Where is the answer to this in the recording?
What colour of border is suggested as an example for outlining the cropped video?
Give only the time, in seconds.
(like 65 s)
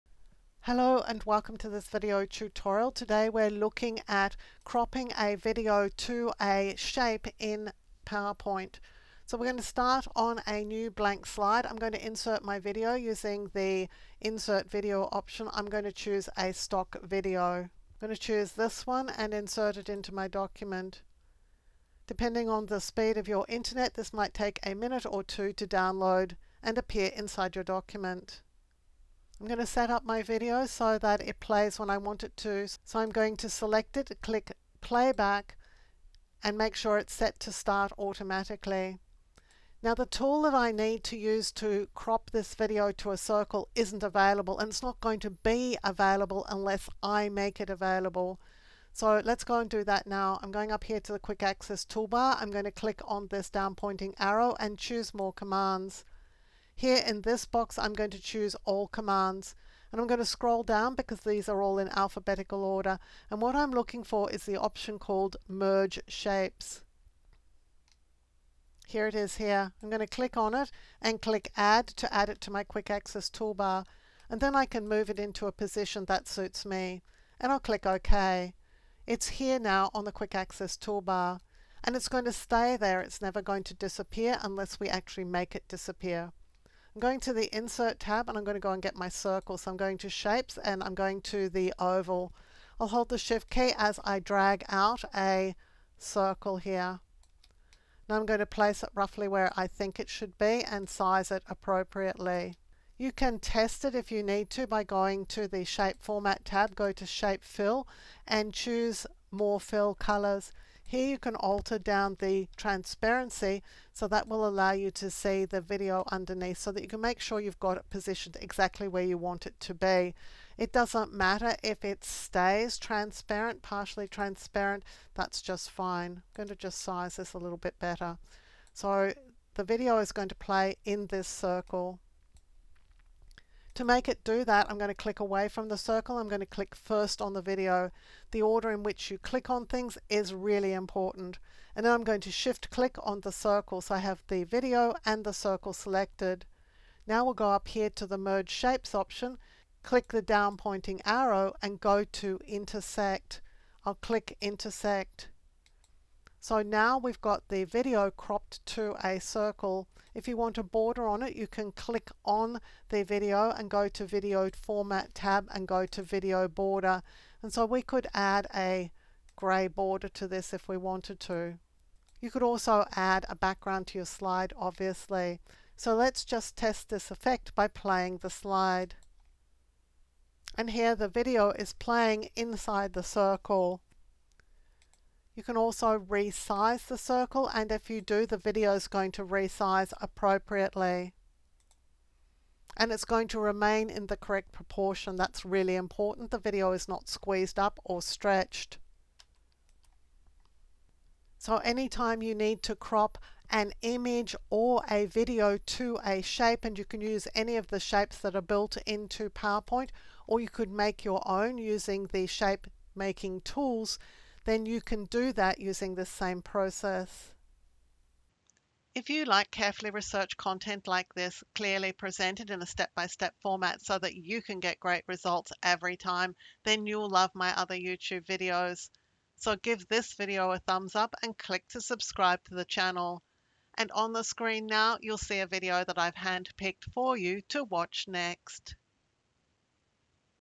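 169 s.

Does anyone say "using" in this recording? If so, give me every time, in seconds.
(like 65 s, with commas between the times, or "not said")
12 s, 211 s, 215 s.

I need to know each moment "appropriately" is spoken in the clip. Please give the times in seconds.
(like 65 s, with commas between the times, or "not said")
101 s, 190 s.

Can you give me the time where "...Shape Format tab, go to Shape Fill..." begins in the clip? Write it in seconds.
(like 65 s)
105 s.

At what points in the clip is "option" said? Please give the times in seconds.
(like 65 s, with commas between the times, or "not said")
15 s, 64 s, 148 s.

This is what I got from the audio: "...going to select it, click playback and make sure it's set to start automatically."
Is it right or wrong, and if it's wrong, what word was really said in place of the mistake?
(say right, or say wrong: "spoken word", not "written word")
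right.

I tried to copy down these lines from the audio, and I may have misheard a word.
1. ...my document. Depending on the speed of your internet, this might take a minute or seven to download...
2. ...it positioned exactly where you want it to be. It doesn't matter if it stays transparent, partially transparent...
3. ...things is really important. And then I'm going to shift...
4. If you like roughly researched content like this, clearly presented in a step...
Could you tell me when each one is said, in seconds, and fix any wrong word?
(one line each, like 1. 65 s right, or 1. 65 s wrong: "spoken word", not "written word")
1. 20 s wrong: "two", not "seven"
2. 117 s right
3. 139 s right
4. 218 s wrong: "carefully", not "roughly".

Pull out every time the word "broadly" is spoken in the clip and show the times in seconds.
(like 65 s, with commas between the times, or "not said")
not said.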